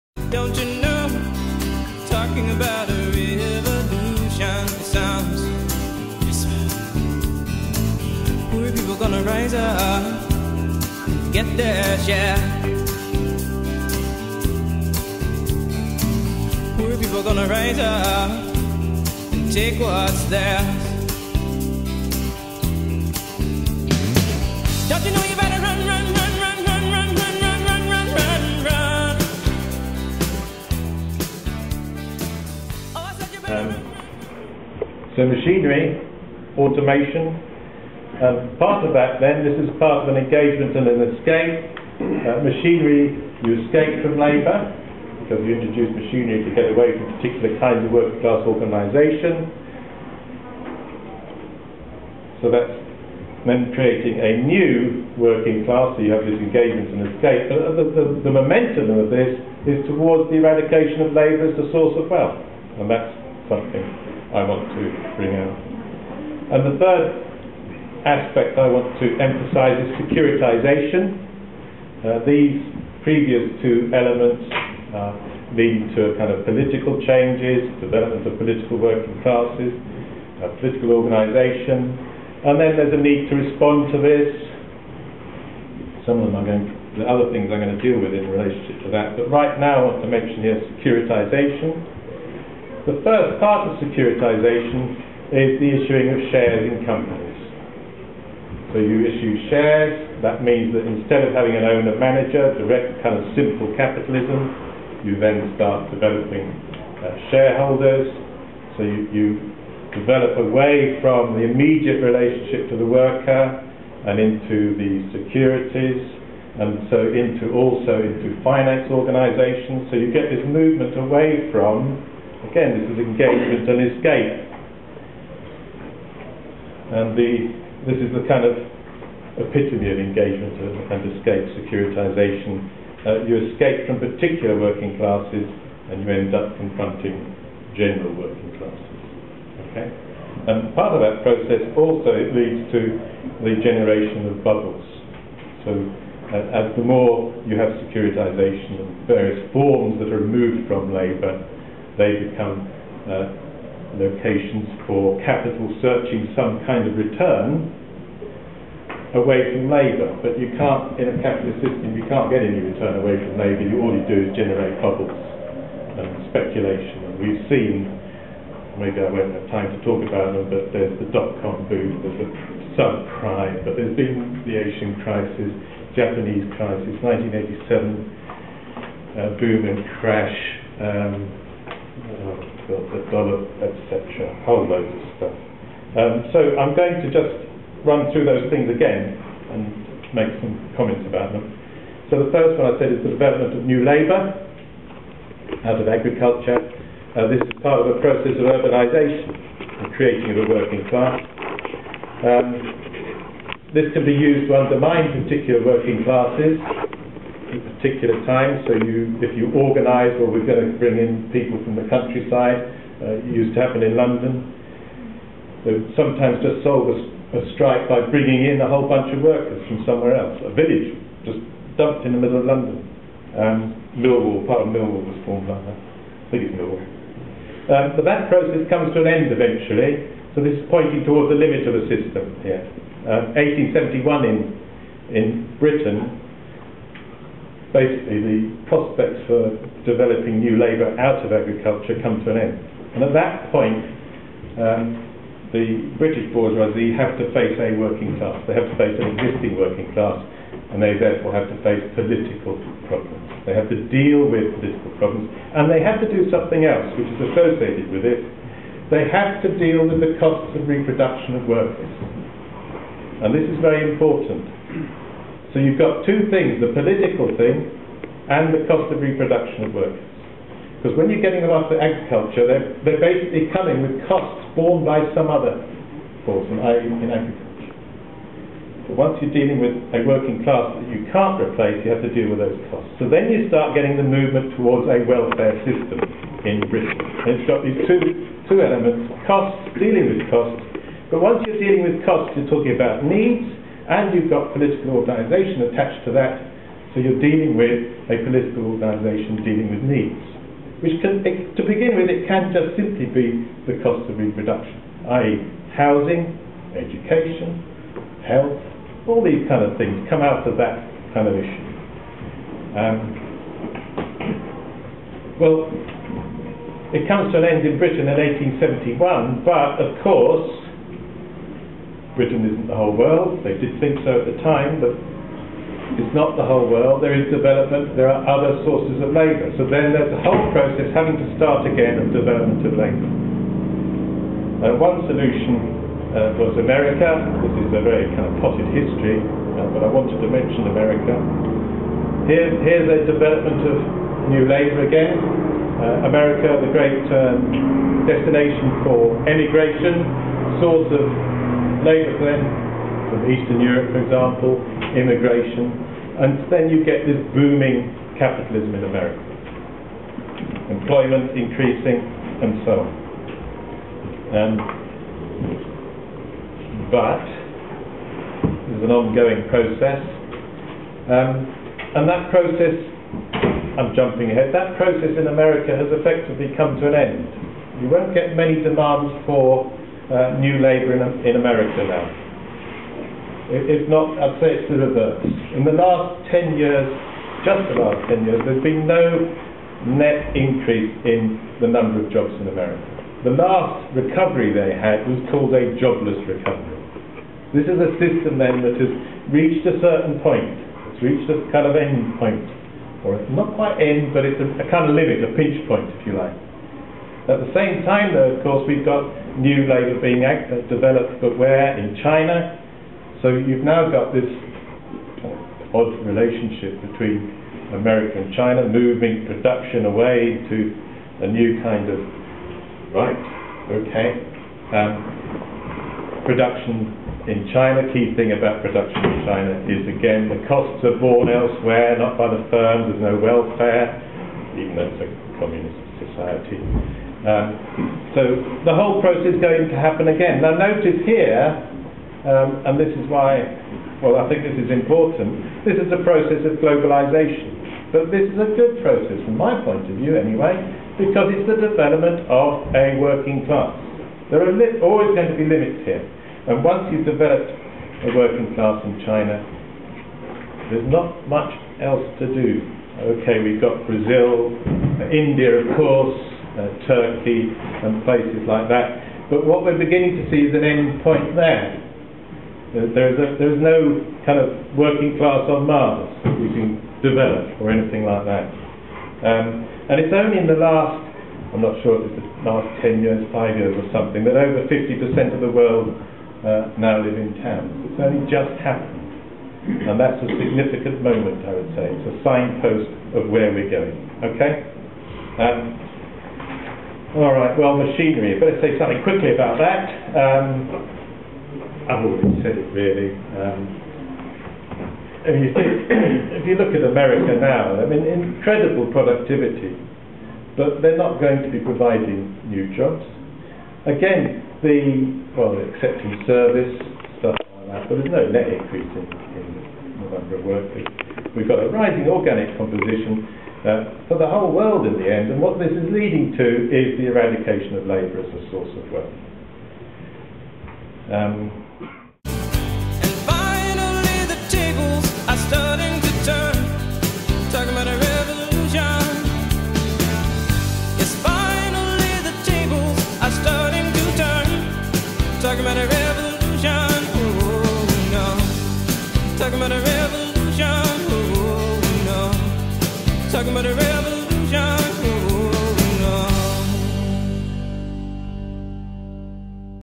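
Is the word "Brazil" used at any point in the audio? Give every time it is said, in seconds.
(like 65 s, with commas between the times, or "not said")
463 s.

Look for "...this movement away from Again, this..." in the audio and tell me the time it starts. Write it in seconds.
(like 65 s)
120 s.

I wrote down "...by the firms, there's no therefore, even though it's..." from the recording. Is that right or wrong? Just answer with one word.
wrong.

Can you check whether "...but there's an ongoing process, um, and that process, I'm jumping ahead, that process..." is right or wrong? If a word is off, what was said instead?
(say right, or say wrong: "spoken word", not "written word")
right.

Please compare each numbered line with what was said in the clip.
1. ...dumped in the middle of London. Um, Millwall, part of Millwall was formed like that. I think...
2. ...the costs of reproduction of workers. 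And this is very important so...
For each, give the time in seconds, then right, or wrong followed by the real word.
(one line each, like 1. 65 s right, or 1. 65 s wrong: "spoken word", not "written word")
1. 221 s right
2. 260 s right.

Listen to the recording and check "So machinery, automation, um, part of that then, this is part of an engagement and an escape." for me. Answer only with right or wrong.
right.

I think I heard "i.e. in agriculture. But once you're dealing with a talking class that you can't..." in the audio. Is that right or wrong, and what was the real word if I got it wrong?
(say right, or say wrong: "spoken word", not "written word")
wrong: "working", not "talking".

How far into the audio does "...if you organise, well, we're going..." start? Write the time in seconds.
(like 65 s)
209 s.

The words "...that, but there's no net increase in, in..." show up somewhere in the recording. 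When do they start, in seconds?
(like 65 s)
517 s.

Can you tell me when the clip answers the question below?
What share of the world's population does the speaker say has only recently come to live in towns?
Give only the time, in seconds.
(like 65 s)
484 s.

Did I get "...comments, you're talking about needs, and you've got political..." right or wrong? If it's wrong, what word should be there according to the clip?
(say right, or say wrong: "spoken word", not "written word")
wrong: "costs", not "comments".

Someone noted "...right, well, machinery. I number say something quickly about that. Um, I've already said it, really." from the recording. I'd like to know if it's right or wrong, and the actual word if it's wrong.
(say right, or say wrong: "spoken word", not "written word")
wrong: "better", not "number".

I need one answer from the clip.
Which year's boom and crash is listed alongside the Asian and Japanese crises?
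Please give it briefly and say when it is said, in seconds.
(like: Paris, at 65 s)
1987, at 177 s.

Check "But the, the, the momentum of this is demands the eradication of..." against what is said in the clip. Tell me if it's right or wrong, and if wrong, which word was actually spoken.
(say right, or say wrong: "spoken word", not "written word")
wrong: "towards", not "demands".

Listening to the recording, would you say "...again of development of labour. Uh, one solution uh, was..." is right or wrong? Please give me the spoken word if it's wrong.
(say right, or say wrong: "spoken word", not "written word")
right.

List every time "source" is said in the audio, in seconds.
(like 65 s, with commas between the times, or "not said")
61 s, 328 s, 350 s, 528 s.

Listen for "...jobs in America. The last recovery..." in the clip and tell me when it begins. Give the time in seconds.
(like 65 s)
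392 s.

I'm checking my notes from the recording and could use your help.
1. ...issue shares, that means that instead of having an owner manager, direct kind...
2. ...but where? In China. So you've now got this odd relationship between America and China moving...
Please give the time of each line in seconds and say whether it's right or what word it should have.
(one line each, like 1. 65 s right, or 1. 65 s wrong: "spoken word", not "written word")
1. 99 s right
2. 411 s right.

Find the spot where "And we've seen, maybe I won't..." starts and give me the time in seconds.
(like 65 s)
167 s.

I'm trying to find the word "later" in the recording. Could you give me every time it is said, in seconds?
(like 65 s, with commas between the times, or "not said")
351 s.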